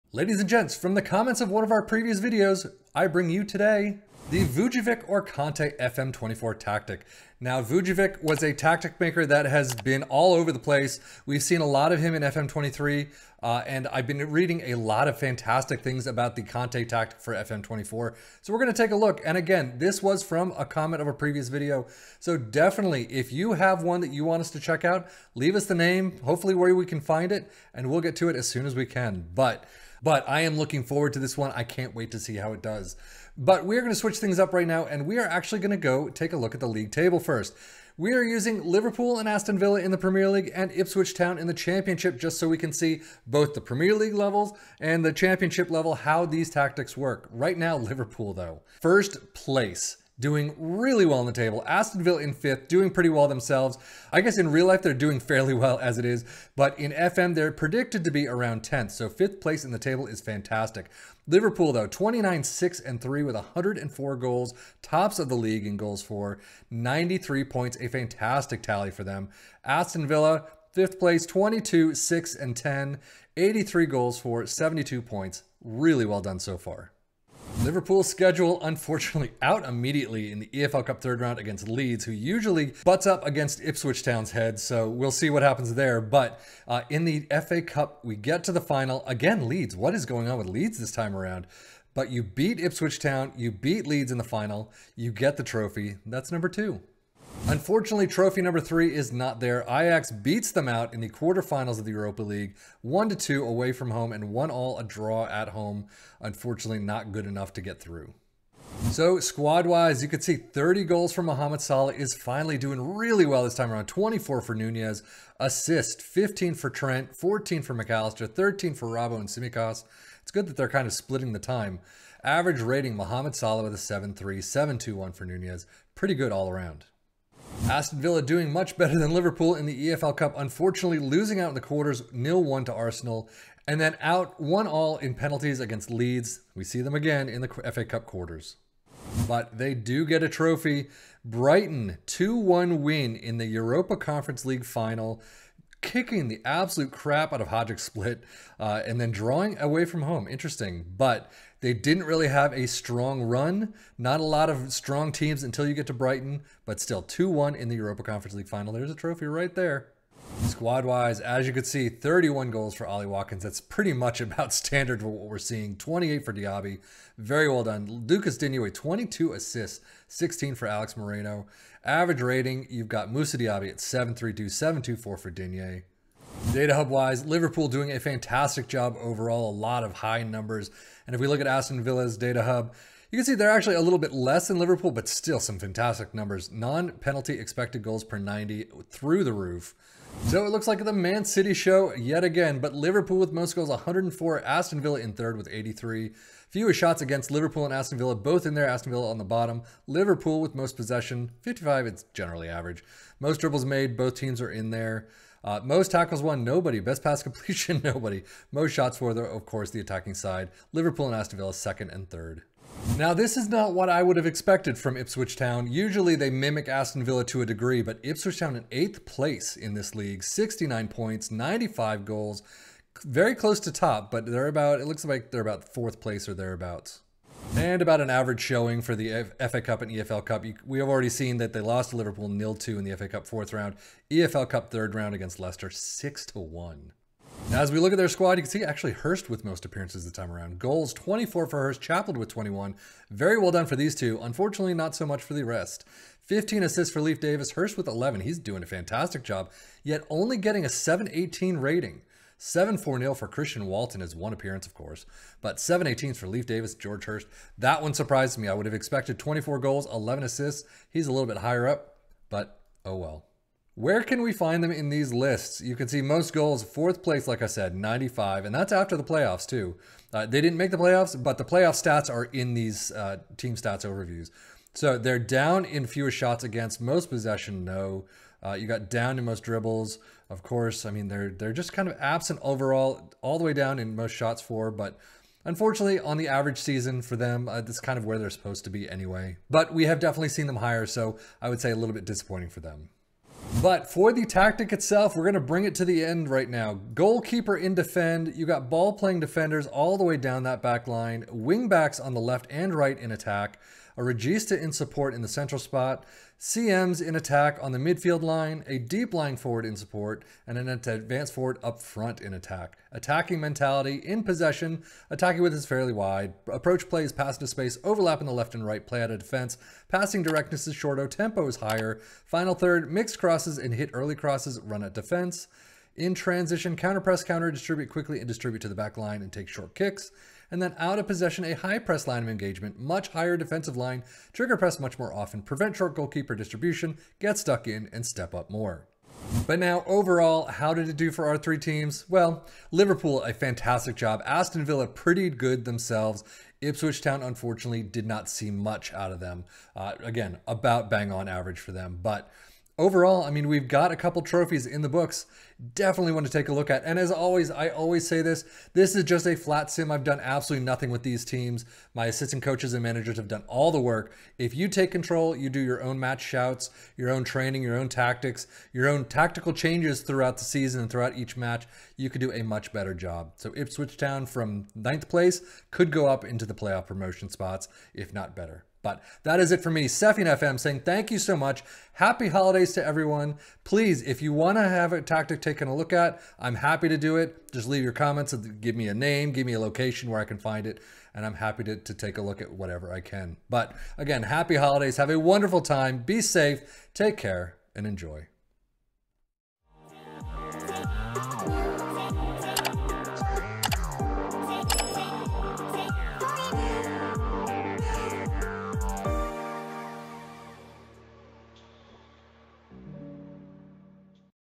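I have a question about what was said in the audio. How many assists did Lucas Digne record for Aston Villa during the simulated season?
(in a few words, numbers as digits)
22.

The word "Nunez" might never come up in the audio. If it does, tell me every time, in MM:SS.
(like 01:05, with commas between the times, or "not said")
01:54, 02:05.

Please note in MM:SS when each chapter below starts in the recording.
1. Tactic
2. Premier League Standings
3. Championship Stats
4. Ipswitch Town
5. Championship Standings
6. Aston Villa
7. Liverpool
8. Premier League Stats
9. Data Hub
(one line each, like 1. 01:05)
1. 04:53
2. 00:37
3. 04:23
4. 03:47
5. 03:32
6. 02:07
7. 01:17
8. 03:10
9. 02:56.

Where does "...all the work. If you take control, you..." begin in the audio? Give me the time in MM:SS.
06:03.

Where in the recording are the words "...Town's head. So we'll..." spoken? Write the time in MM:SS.
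01:24.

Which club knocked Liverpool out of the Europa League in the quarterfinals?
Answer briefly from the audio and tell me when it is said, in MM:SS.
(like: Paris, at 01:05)
Ajax, at 01:39.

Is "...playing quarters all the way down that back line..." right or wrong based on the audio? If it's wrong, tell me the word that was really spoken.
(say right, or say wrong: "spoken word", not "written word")
wrong: "defenders", not "quarters".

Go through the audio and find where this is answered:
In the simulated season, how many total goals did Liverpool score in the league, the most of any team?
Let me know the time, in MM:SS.
01:03.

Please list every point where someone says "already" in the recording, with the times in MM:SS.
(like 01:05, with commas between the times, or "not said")
03:50.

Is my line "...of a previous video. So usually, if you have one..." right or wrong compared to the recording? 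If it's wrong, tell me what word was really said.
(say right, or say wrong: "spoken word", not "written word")
wrong: "definitely", not "usually".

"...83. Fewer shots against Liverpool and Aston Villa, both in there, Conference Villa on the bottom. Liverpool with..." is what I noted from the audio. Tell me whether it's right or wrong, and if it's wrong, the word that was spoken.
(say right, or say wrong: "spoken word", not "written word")
wrong: "Aston", not "Conference".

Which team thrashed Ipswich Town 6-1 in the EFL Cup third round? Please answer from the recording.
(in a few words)
Leicester.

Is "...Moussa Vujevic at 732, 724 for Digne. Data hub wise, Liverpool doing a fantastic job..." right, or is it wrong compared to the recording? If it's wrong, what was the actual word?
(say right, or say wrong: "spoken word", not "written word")
wrong: "Diaby", not "Vujevic".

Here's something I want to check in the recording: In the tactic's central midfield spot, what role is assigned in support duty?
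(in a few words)
Regista.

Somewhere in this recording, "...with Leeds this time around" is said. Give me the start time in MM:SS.
01:30.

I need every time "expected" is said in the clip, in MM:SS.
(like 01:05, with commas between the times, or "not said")
03:07, 03:34, 04:18.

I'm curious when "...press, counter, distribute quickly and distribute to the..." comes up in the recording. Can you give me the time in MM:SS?
05:27.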